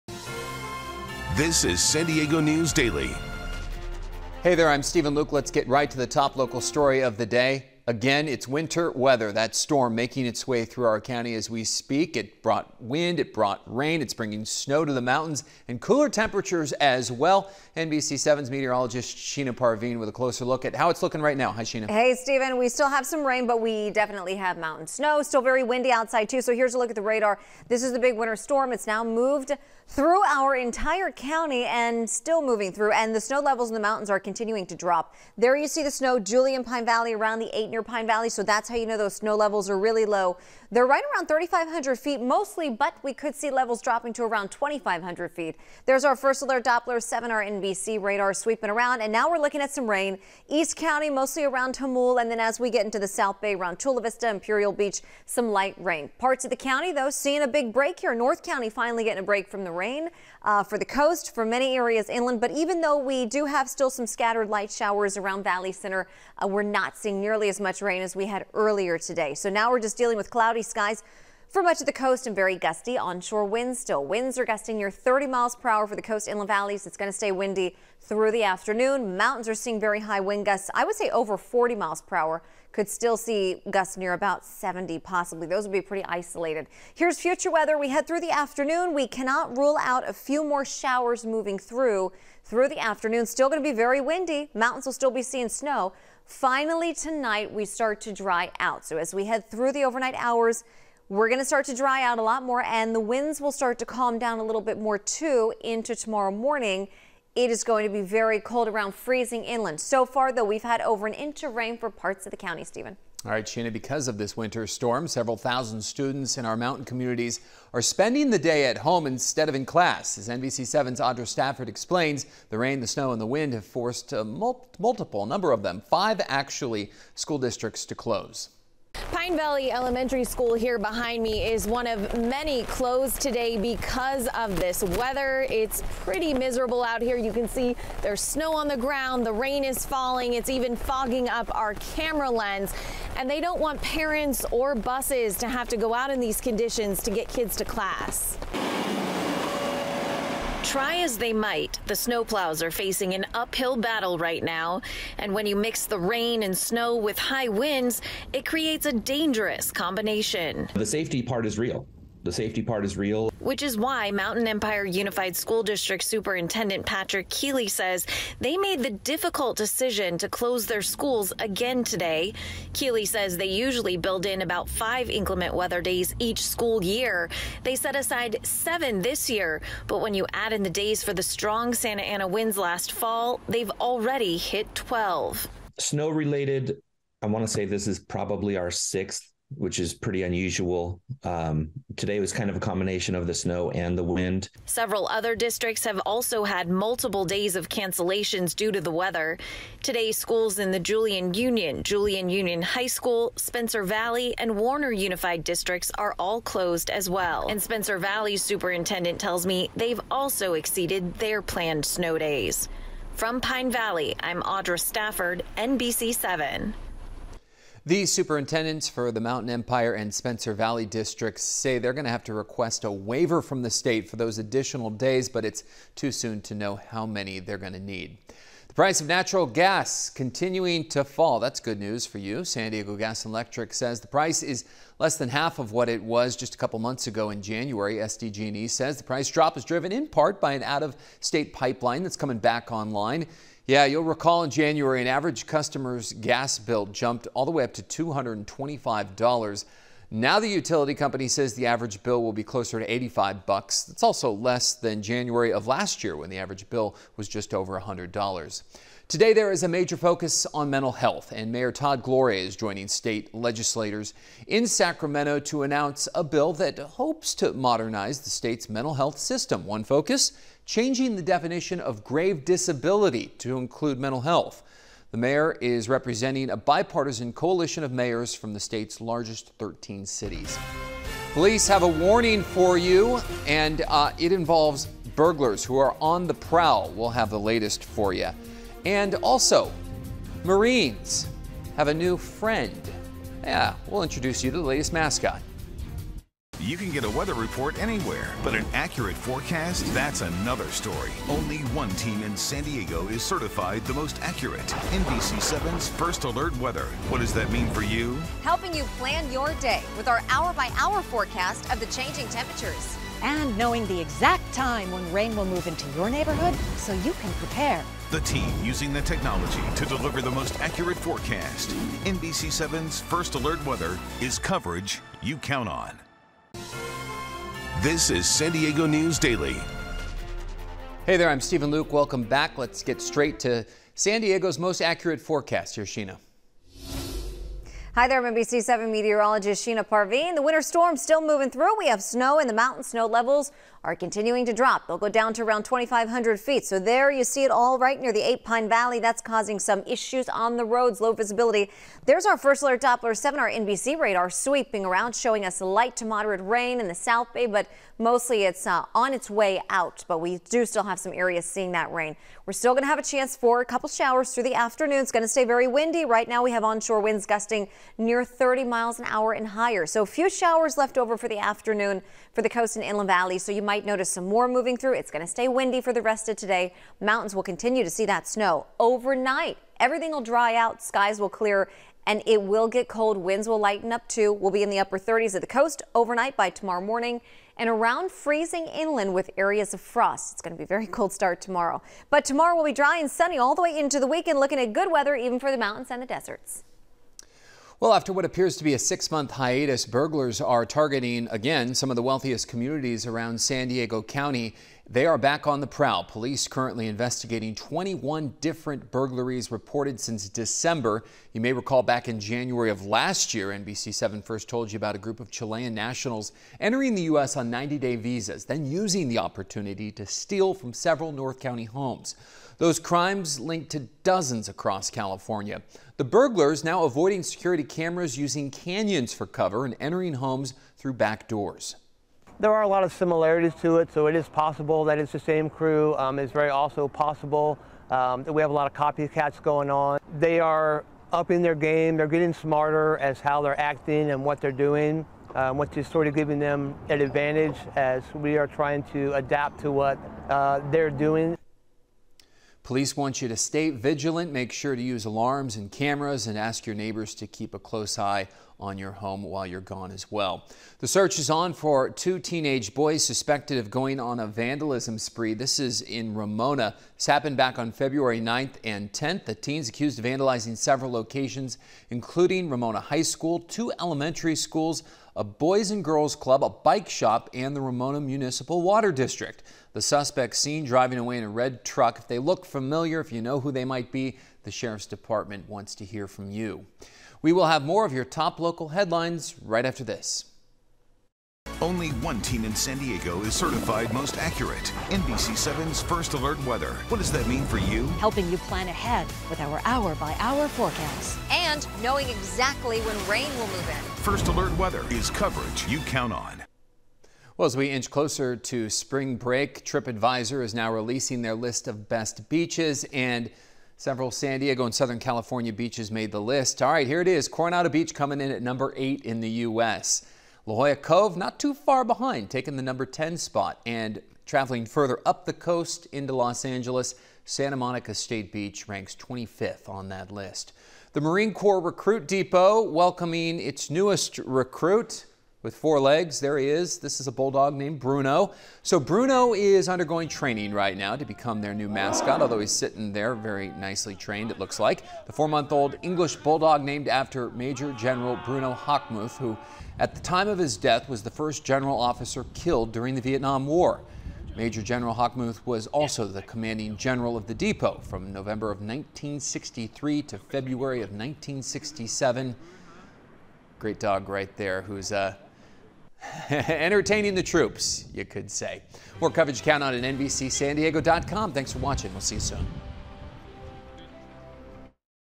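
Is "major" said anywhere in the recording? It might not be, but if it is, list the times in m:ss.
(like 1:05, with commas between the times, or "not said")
4:19, 9:07, 9:14.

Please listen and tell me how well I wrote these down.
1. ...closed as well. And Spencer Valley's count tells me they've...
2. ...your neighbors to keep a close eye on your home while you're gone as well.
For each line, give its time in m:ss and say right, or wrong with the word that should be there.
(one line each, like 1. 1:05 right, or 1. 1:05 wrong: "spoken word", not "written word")
1. 3:26 wrong: "superintendent", not "count"
2. 7:36 right.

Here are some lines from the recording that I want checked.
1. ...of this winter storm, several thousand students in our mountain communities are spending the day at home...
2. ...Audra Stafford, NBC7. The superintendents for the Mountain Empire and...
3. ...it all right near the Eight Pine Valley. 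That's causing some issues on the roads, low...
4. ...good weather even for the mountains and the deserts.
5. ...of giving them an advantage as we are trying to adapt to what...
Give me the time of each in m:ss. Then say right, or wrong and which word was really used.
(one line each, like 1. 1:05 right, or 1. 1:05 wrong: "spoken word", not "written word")
1. 1:54 right
2. 3:34 right
3. 5:47 right
4. 6:34 right
5. 7:26 right.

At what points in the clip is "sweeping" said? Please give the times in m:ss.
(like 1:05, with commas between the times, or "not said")
0:48, 5:54.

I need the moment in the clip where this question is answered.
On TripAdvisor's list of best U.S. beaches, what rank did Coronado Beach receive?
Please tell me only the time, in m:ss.
8:38.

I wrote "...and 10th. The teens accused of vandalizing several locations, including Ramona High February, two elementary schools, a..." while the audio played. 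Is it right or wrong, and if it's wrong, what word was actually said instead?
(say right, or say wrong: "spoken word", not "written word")
wrong: "School", not "February".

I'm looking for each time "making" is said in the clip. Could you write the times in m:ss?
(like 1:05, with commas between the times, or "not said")
0:09.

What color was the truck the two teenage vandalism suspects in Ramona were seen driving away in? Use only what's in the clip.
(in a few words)
Red.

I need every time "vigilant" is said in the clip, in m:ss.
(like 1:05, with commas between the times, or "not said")
7:33.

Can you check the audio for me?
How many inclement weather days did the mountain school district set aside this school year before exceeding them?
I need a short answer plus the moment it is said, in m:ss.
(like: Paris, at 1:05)
7, at 2:58.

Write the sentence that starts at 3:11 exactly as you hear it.
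Um, today was kind of a combination of the snow and the wind.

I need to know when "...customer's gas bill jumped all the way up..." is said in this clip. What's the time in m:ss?
4:05.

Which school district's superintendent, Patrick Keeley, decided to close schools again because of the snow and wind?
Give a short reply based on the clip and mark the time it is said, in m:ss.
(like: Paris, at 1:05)
Mountain Empire Unified, at 2:44.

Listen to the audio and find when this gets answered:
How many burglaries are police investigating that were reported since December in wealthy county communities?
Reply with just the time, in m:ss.
6:47.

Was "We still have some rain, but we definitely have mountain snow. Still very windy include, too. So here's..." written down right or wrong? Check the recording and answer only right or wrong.
wrong.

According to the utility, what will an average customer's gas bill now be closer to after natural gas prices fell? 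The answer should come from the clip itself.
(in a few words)
$85.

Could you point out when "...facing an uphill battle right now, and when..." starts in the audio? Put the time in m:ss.
2:32.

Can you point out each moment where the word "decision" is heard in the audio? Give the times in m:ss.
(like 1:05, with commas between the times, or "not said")
2:49.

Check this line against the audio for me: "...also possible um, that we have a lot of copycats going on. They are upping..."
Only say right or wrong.
right.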